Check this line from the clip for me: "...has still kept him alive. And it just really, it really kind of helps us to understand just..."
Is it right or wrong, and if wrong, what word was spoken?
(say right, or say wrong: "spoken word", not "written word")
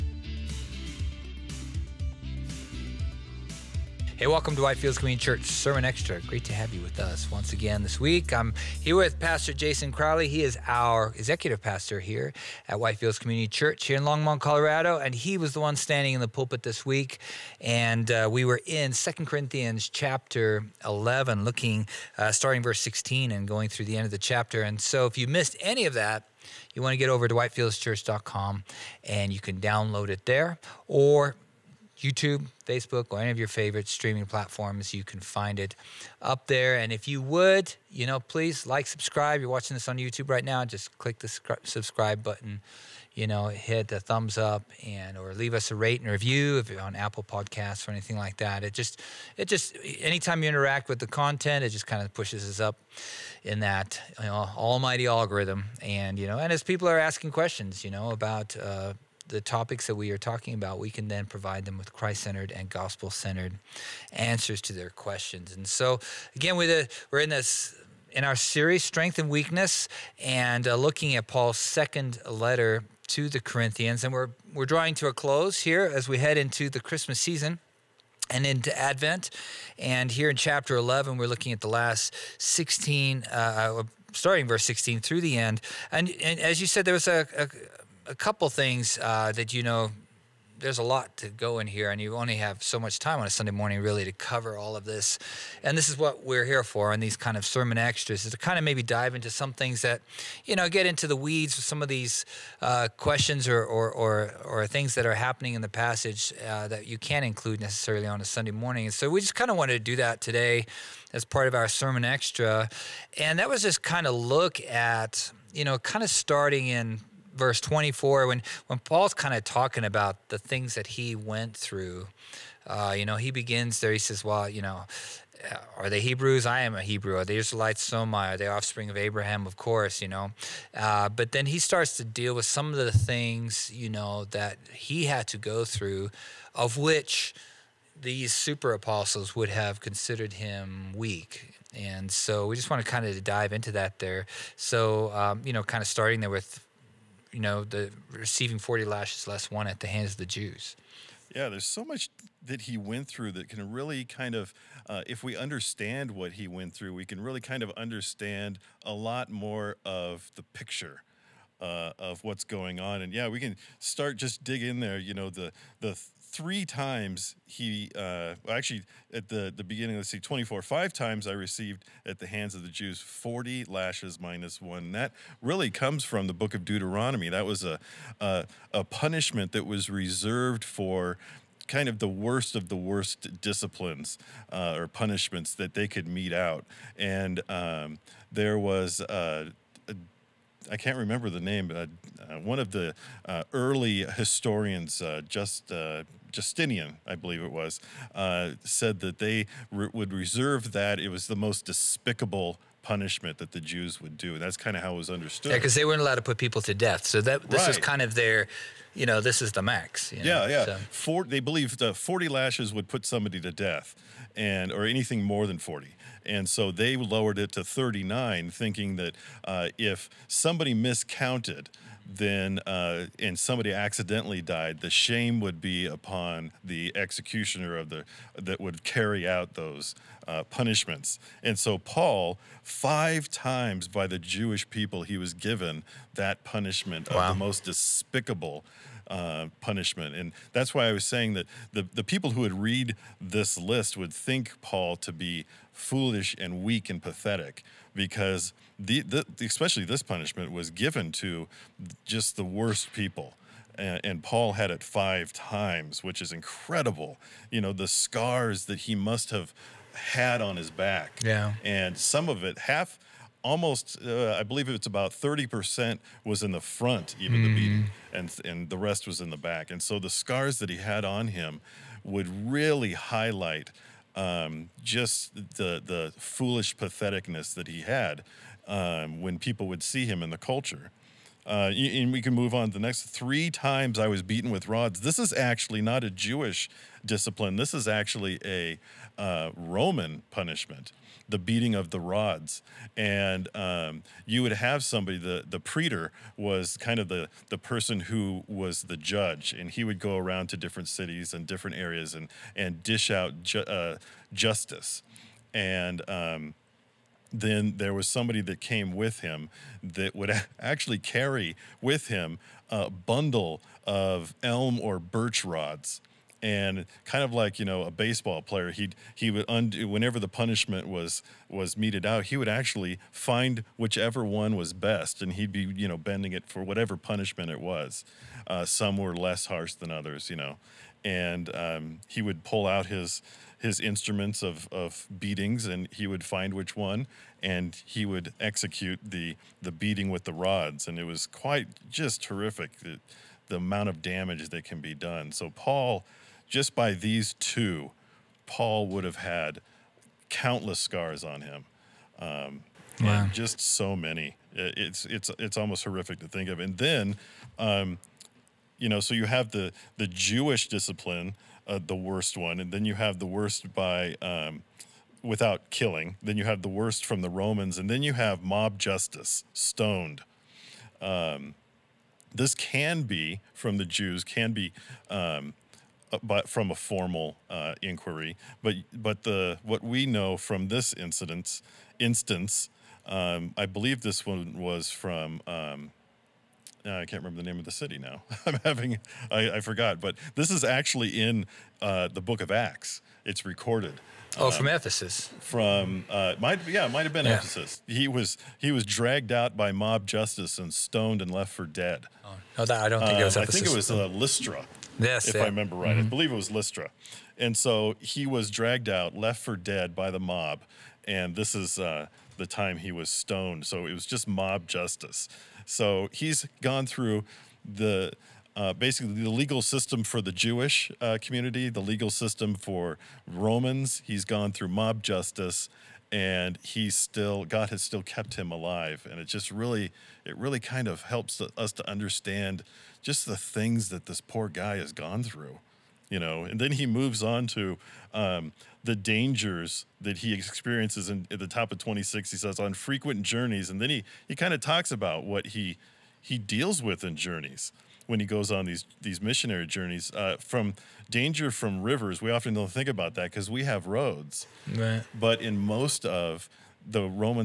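right.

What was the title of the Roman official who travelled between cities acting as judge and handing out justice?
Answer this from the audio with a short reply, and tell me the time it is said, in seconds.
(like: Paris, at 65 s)
praetor, at 295 s.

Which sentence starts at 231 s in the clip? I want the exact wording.
And so Paul, five times by the Jewish people, he was given that punishment wow.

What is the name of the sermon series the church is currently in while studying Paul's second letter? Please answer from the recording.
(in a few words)
Strength and Weakness.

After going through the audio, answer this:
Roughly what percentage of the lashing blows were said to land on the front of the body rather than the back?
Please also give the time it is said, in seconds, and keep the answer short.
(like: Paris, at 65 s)
30%, at 265 s.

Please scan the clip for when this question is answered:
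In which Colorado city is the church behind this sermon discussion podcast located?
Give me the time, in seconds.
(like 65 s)
14 s.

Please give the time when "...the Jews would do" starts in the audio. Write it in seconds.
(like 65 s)
203 s.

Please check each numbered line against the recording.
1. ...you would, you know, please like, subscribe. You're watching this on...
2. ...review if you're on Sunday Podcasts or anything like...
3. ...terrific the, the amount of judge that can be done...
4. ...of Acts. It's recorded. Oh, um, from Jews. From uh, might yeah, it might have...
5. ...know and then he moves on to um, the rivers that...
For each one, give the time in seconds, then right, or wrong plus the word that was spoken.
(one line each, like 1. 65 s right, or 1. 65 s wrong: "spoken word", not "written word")
1. 37 s right
2. 46 s wrong: "Apple", not "Sunday"
3. 342 s wrong: "damage", not "judge"
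4. 392 s wrong: "Ephesus", not "Jews"
5. 436 s wrong: "dangers", not "rivers".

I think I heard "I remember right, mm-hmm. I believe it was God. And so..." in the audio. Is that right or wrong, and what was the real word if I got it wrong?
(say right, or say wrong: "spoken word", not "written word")
wrong: "Lystra", not "God".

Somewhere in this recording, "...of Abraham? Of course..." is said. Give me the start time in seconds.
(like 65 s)
128 s.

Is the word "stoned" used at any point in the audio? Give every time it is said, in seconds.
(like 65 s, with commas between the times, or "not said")
369 s, 400 s, 413 s.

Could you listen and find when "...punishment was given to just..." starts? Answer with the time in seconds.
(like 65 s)
250 s.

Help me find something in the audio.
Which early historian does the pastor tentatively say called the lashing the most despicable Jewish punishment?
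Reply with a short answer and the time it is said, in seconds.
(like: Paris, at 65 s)
Justinian, at 196 s.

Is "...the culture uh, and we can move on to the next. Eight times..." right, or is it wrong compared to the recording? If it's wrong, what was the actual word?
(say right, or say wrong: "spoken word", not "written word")
wrong: "Three", not "Eight".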